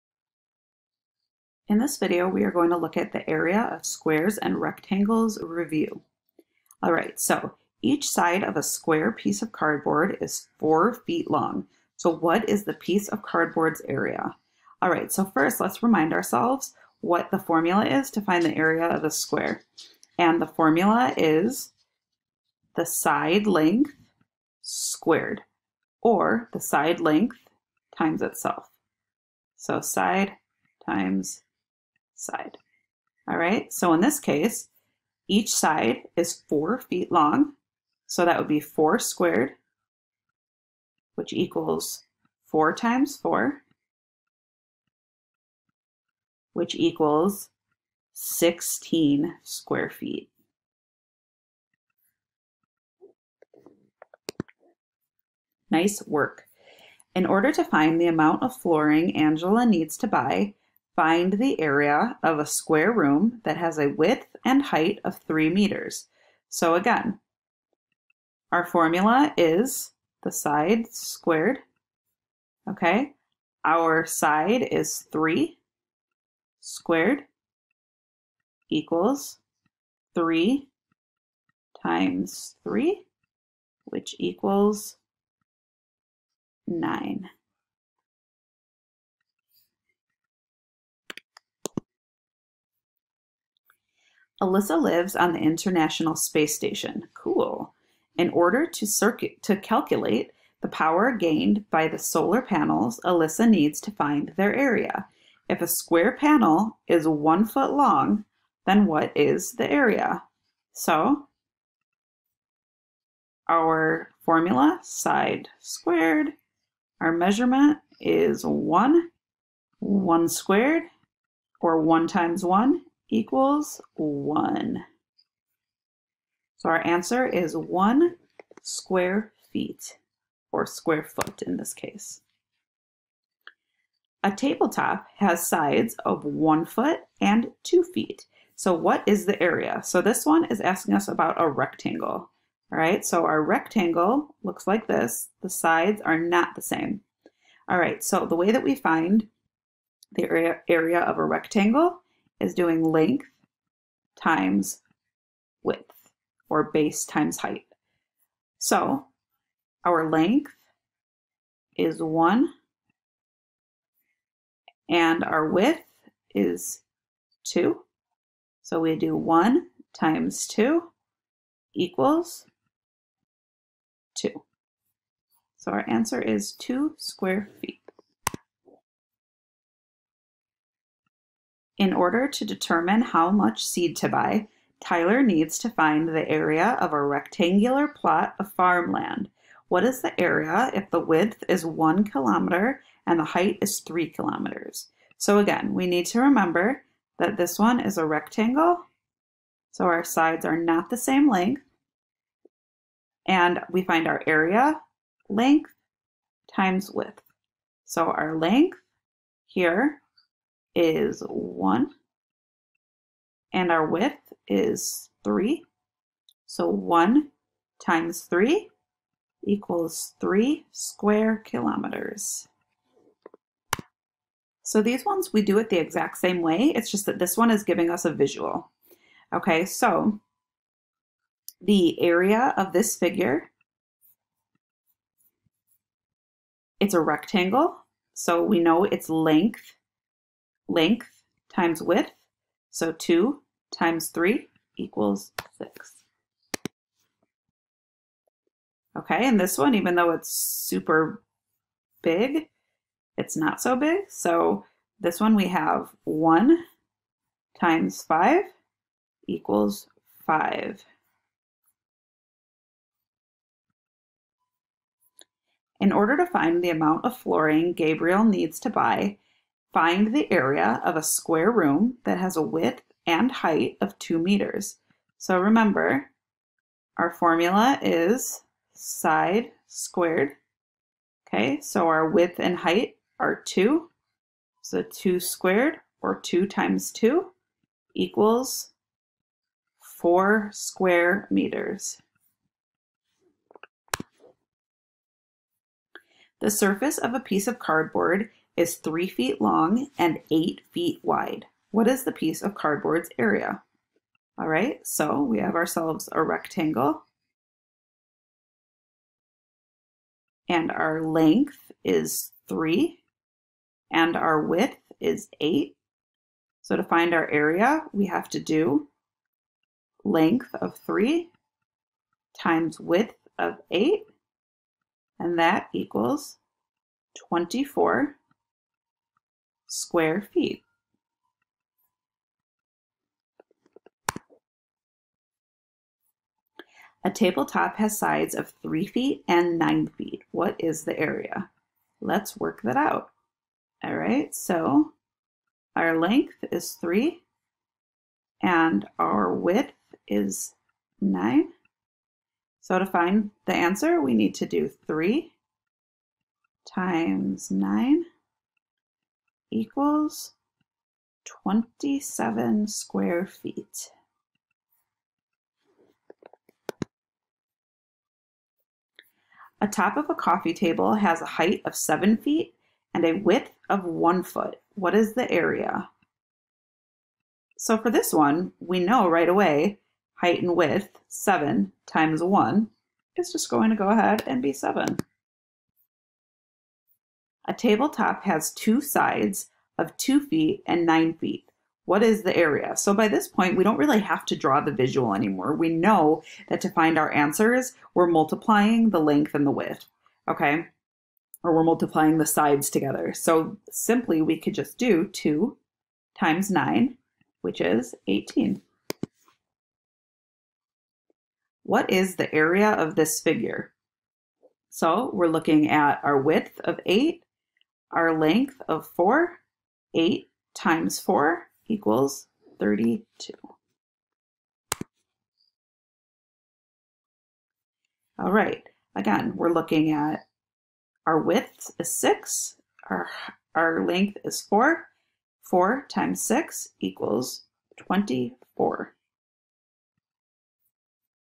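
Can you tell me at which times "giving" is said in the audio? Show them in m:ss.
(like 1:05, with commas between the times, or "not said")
3:47.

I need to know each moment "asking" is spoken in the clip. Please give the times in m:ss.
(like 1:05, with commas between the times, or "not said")
2:20.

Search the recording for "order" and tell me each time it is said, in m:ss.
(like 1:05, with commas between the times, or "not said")
0:57, 1:38, 3:01, 4:25.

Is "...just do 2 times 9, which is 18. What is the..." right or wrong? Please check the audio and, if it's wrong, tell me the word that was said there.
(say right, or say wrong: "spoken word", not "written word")
right.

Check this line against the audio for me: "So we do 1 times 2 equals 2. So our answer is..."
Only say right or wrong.
right.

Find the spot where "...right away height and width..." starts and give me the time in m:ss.
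6:19.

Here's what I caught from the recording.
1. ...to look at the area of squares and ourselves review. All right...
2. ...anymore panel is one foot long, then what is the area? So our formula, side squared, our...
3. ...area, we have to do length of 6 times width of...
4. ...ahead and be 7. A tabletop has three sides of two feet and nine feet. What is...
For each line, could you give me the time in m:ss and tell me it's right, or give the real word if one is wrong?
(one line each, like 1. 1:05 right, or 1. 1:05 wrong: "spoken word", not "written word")
1. 0:02 wrong: "rectangles", not "ourselves"
2. 1:45 wrong: "square", not "anymore"
3. 5:17 wrong: "3", not "6"
4. 6:23 wrong: "two", not "three".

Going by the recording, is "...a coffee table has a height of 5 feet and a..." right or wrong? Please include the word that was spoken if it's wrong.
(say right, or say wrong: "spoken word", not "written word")
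wrong: "7", not "5".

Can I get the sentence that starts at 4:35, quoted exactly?
So remember, our formula is side squared.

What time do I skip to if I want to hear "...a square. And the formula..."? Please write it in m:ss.
0:19.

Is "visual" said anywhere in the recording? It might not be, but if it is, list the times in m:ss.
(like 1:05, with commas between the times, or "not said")
3:48, 6:34.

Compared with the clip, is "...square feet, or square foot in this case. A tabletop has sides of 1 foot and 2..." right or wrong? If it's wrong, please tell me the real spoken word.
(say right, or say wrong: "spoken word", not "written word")
right.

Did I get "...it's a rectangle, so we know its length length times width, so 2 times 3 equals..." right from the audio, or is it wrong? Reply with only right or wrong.
right.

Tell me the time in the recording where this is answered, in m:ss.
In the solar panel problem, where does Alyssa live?
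1:35.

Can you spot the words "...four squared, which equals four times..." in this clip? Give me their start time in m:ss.
0:38.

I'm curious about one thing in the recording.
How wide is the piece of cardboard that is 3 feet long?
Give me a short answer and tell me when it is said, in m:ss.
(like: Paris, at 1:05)
8 feet, at 5:00.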